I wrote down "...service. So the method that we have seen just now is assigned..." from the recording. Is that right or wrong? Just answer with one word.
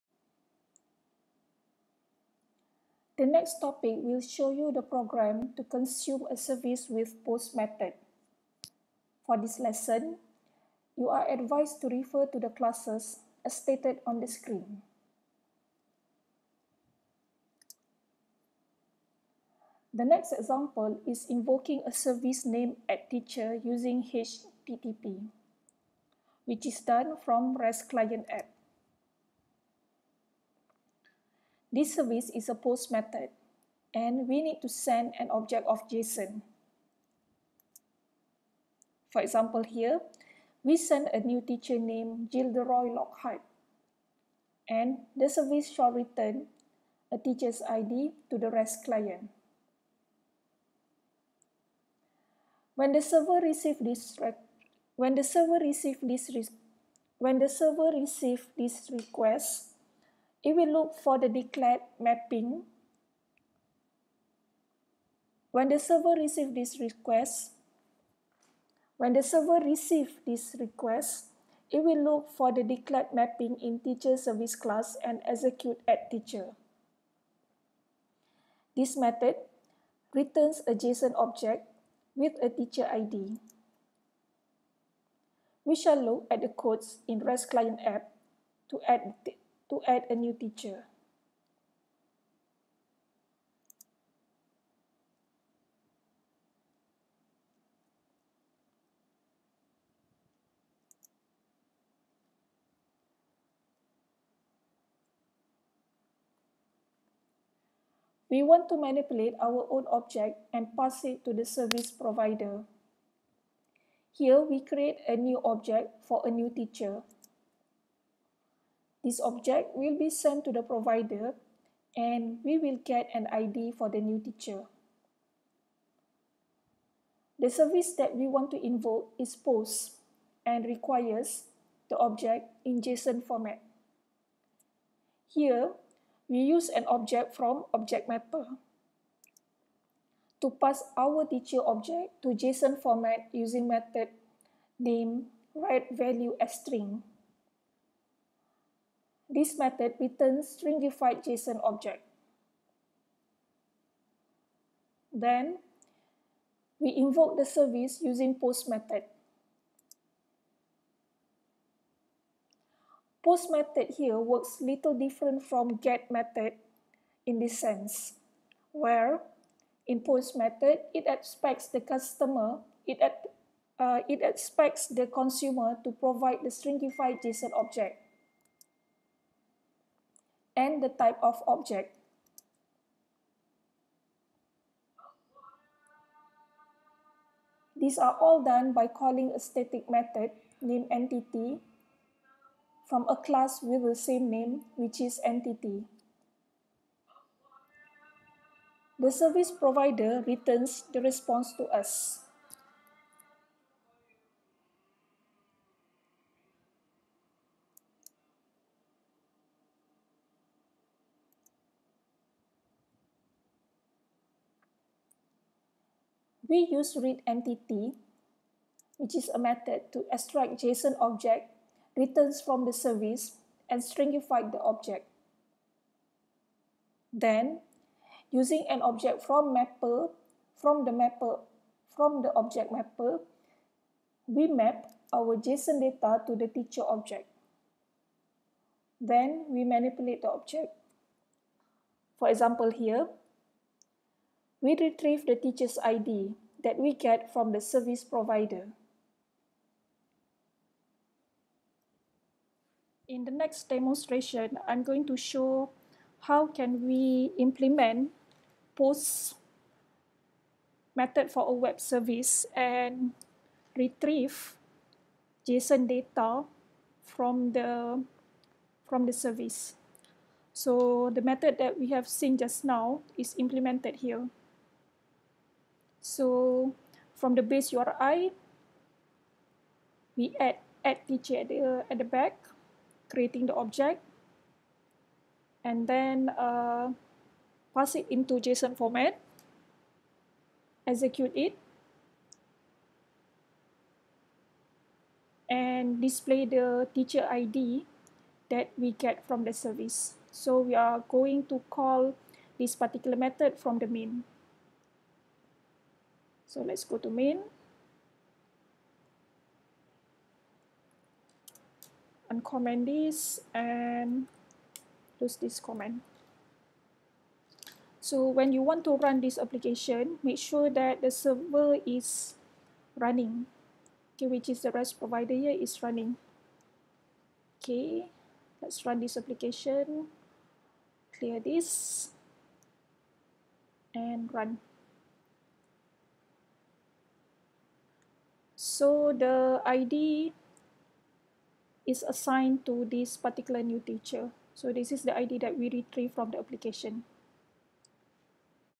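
wrong.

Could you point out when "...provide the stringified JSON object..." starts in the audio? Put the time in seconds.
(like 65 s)
175 s.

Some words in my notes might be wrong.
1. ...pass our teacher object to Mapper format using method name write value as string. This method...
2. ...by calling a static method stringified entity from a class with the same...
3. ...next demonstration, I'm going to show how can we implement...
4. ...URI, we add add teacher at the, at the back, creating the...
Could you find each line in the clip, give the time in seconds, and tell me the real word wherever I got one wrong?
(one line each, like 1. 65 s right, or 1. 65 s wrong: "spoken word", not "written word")
1. 140 s wrong: "JSON", not "Mapper"
2. 188 s wrong: "named", not "stringified"
3. 253 s right
4. 277 s right.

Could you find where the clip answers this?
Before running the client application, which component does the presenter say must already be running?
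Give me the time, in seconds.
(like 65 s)
324 s.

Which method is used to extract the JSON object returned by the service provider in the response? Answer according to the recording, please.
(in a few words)
read entity.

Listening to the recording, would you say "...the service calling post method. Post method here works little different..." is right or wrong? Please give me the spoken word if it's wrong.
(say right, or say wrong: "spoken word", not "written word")
wrong: "using", not "calling".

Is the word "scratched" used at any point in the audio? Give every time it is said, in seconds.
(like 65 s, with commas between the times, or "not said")
not said.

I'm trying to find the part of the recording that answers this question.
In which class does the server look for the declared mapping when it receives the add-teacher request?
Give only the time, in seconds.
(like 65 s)
73 s.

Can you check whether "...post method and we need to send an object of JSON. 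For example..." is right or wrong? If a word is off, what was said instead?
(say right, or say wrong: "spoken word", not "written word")
right.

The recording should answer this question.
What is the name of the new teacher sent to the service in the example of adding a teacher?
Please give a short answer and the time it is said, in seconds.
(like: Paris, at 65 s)
Gilderoy Lockhart, at 42 s.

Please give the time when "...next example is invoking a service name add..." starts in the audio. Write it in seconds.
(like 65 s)
20 s.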